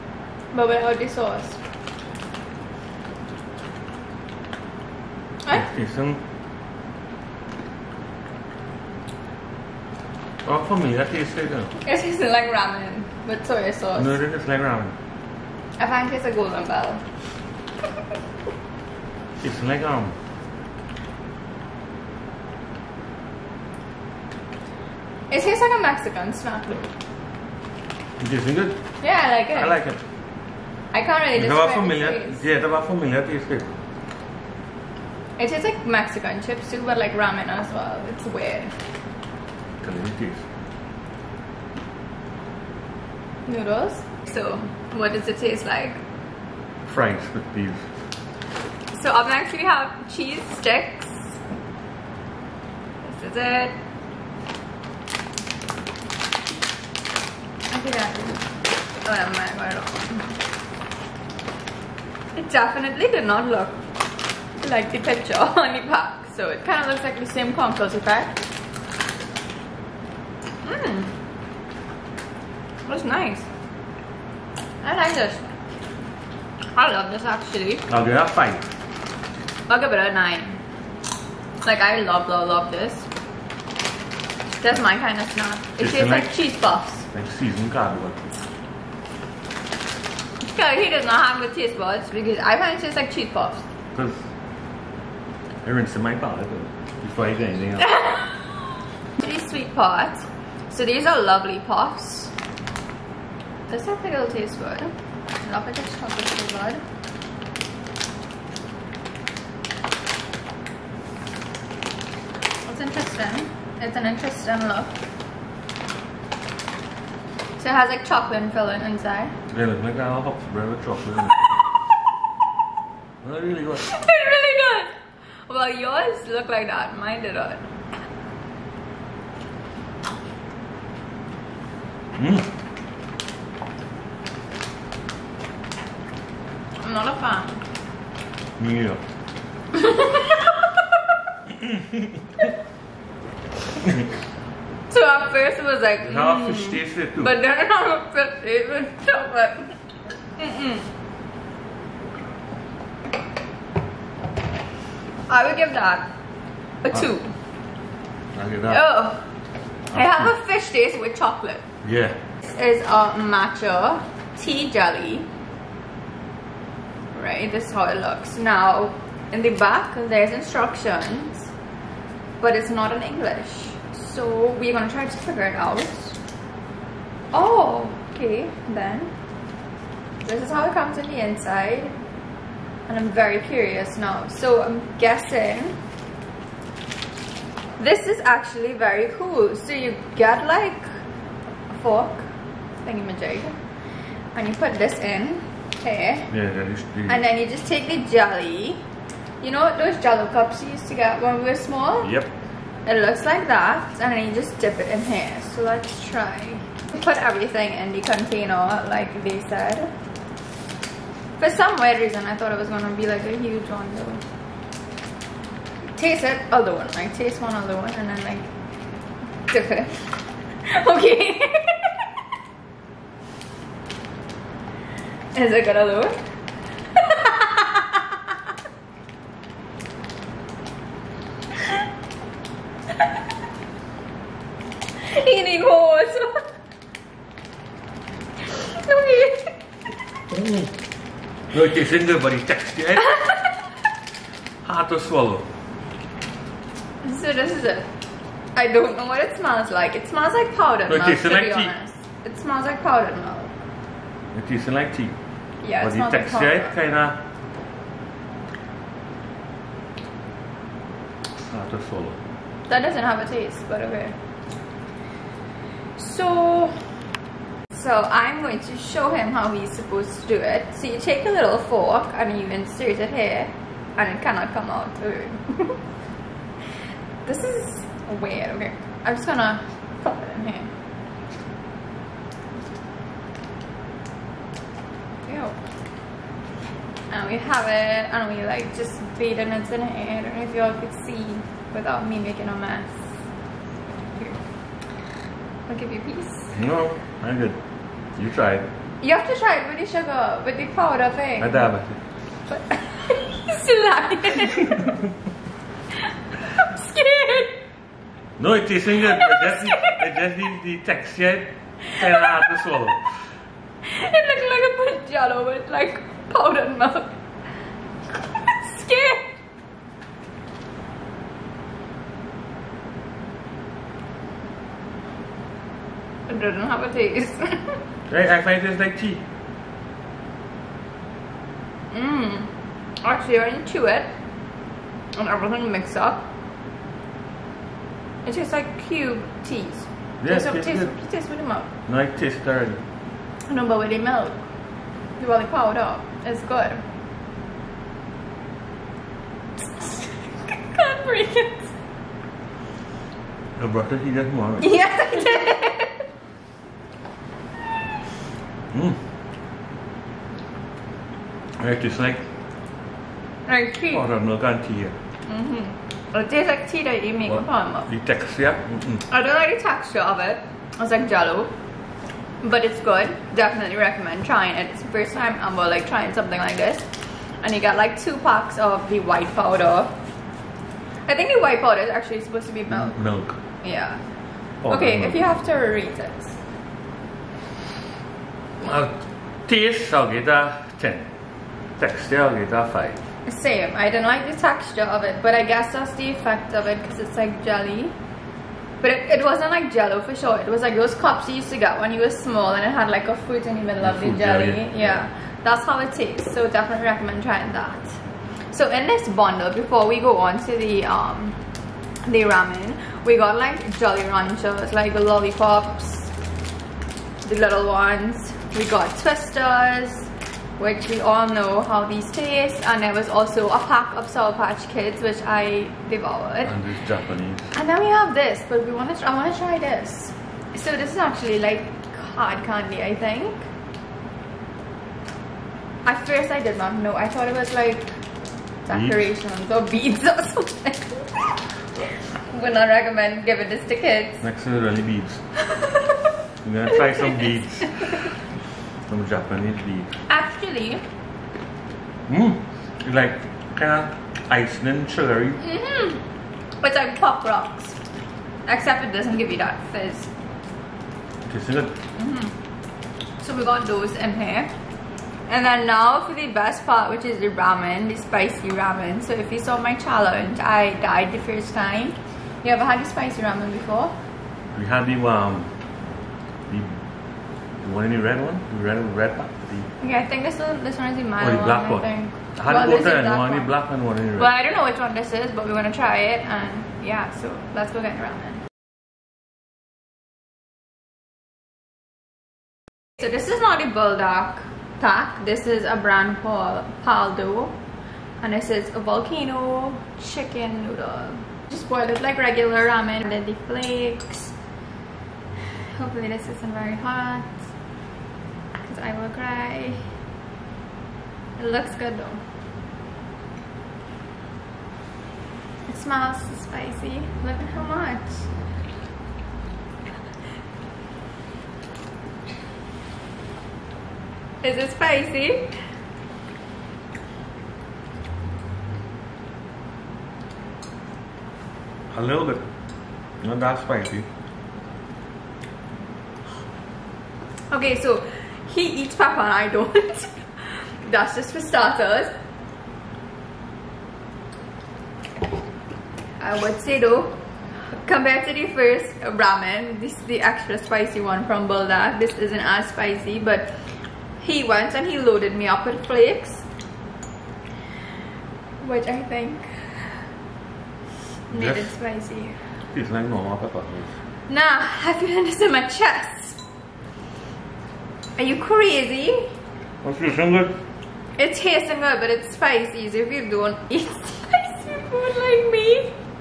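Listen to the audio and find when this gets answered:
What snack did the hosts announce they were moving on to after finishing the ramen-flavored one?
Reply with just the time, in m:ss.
0:50.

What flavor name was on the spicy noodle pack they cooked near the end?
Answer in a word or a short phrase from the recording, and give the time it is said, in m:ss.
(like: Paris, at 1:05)
volcano chicken, at 8:18.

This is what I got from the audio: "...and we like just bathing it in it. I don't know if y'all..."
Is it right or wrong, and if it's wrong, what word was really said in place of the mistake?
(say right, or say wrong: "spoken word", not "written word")
right.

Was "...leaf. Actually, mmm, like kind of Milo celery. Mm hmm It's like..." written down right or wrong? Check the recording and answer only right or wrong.
wrong.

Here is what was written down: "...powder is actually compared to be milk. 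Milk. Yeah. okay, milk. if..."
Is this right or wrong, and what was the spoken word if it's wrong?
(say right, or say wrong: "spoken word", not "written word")
wrong: "supposed", not "compared".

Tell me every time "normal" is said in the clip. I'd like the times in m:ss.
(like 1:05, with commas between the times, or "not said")
9:23.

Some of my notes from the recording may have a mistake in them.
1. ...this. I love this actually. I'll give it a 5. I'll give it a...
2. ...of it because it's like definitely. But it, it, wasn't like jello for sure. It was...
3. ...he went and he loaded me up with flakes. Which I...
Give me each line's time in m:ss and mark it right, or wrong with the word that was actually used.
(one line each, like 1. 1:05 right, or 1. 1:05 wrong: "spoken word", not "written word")
1. 1:15 right
2. 6:36 wrong: "jelly", not "definitely"
3. 9:14 right.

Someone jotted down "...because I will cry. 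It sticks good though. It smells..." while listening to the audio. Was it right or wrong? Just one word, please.
wrong.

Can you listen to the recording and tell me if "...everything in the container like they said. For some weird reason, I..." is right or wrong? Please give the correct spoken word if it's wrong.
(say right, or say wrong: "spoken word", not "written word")
right.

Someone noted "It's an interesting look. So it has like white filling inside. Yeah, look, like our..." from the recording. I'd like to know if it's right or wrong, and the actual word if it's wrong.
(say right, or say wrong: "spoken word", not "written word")
wrong: "chocolate", not "white".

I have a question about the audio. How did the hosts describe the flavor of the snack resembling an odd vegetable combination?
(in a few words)
Fries with peas.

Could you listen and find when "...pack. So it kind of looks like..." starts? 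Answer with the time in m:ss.
1:05.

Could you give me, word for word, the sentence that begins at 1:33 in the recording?
Because I rinsed my palate before I did anything else.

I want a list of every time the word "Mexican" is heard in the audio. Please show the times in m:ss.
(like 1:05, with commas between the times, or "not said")
0:25, 0:35.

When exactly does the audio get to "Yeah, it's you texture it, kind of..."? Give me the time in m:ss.
4:15.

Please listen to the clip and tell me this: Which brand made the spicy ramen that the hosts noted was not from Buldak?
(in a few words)
Paldo.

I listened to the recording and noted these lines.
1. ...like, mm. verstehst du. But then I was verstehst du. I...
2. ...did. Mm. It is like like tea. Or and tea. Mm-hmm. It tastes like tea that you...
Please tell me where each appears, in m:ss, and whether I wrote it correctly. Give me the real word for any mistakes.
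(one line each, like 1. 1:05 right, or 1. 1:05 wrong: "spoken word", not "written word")
1. 2:25 right
2. 5:55 right.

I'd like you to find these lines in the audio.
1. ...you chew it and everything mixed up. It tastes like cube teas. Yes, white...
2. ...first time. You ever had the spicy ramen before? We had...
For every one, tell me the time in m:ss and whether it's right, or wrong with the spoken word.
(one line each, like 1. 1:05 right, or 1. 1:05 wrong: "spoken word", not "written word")
1. 5:33 wrong: "taste", not "white"
2. 7:51 right.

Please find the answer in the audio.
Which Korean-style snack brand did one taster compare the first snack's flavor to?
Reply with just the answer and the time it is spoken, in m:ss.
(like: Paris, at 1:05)
golden bell, at 0:16.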